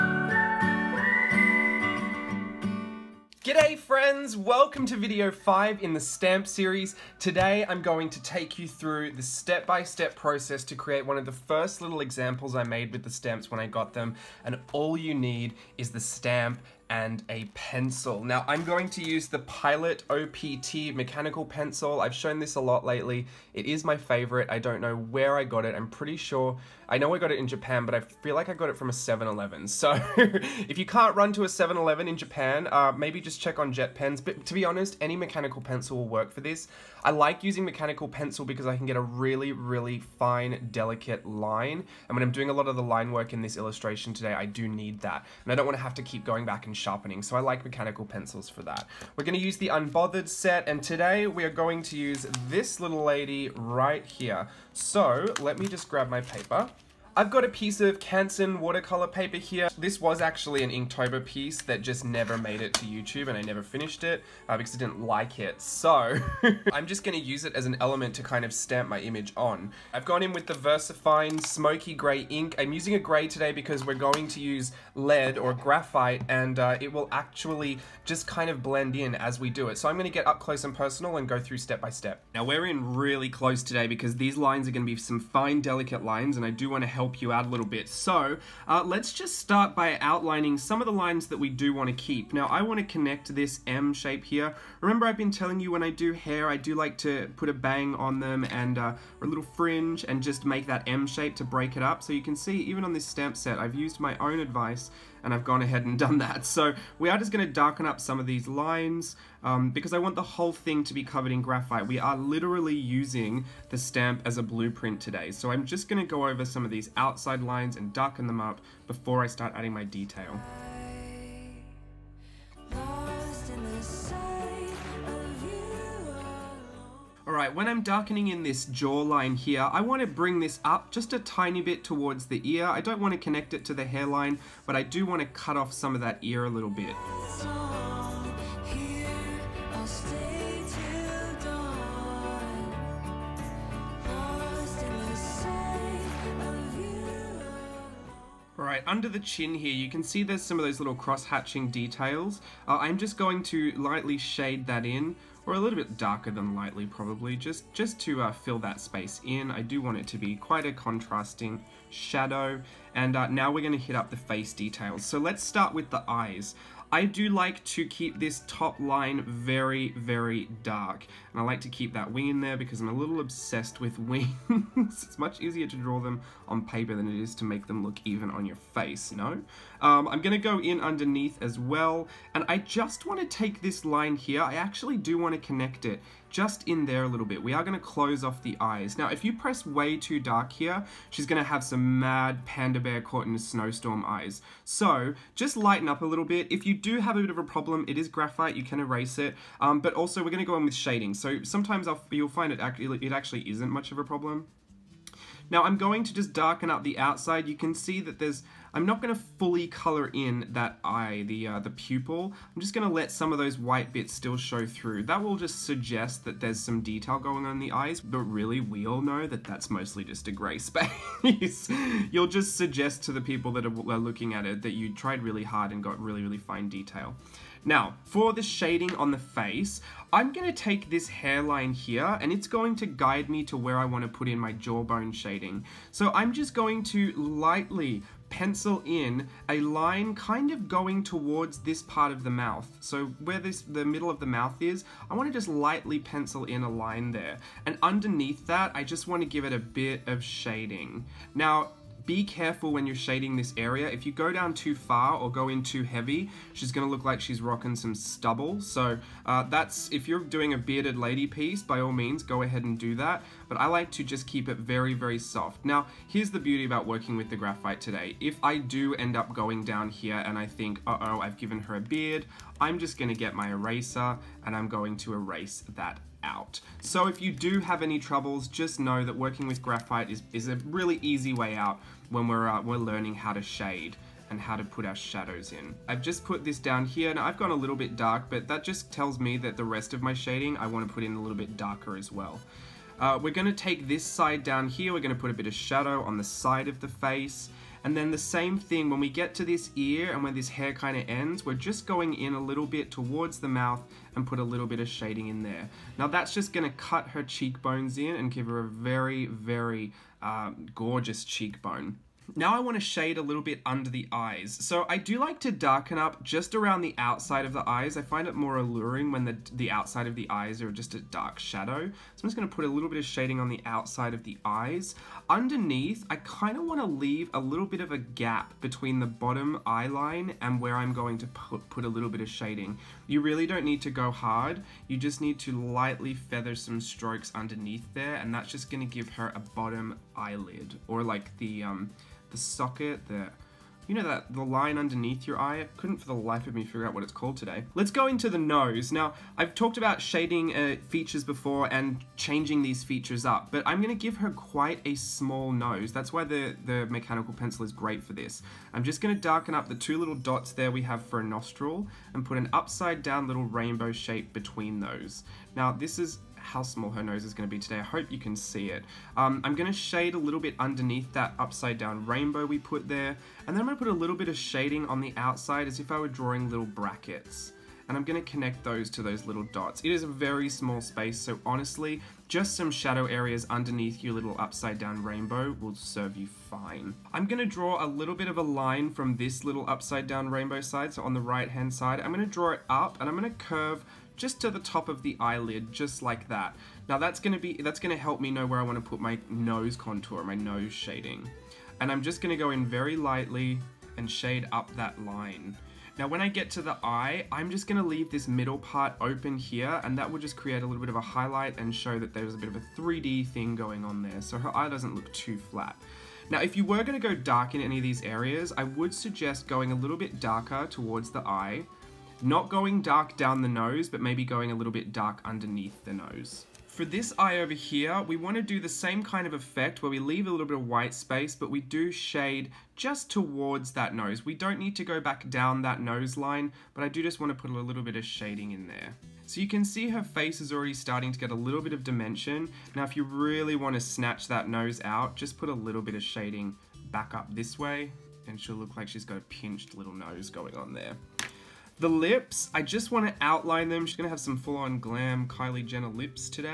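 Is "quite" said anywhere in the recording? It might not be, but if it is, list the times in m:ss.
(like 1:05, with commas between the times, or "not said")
2:40, 5:54.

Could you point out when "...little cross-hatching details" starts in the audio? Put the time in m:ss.
2:30.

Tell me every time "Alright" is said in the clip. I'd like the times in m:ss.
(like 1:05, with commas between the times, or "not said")
2:07, 2:28.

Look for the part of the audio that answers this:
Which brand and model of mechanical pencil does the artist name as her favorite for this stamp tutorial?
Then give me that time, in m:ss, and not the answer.
0:19.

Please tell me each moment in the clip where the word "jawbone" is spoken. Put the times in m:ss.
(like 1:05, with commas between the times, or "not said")
3:54.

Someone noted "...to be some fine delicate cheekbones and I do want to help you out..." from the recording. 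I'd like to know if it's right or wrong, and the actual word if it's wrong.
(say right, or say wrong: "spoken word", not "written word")
wrong: "lines", not "cheekbones".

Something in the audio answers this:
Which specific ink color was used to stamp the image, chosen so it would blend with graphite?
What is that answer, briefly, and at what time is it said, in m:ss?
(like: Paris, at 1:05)
VersaFine Smoky Gray, at 1:10.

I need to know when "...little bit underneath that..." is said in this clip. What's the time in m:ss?
6:10.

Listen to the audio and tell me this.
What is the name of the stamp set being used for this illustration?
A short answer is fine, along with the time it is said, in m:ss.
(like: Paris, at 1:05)
Unbothered, at 0:49.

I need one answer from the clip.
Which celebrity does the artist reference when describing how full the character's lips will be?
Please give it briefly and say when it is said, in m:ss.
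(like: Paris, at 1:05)
Kylie Jenner, at 7:35.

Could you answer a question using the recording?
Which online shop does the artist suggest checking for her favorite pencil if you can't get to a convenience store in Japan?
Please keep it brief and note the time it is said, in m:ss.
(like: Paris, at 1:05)
JetPens, at 0:33.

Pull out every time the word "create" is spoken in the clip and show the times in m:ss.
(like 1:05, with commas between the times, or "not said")
0:10, 6:50.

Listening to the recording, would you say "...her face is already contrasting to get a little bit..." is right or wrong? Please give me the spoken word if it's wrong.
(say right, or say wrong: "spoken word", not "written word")
wrong: "starting", not "contrasting".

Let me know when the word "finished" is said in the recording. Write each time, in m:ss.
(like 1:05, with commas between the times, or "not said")
1:03.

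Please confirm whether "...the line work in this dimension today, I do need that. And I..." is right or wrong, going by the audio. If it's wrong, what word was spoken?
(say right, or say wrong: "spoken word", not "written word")
wrong: "illustration", not "dimension".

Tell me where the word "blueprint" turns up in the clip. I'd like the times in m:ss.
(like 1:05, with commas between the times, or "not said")
1:54.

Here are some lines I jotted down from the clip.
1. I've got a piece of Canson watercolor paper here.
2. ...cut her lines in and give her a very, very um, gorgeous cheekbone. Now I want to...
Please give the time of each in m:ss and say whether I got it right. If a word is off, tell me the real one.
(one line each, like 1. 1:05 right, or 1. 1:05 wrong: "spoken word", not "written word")
1. 0:57 right
2. 5:06 wrong: "cheekbones", not "lines".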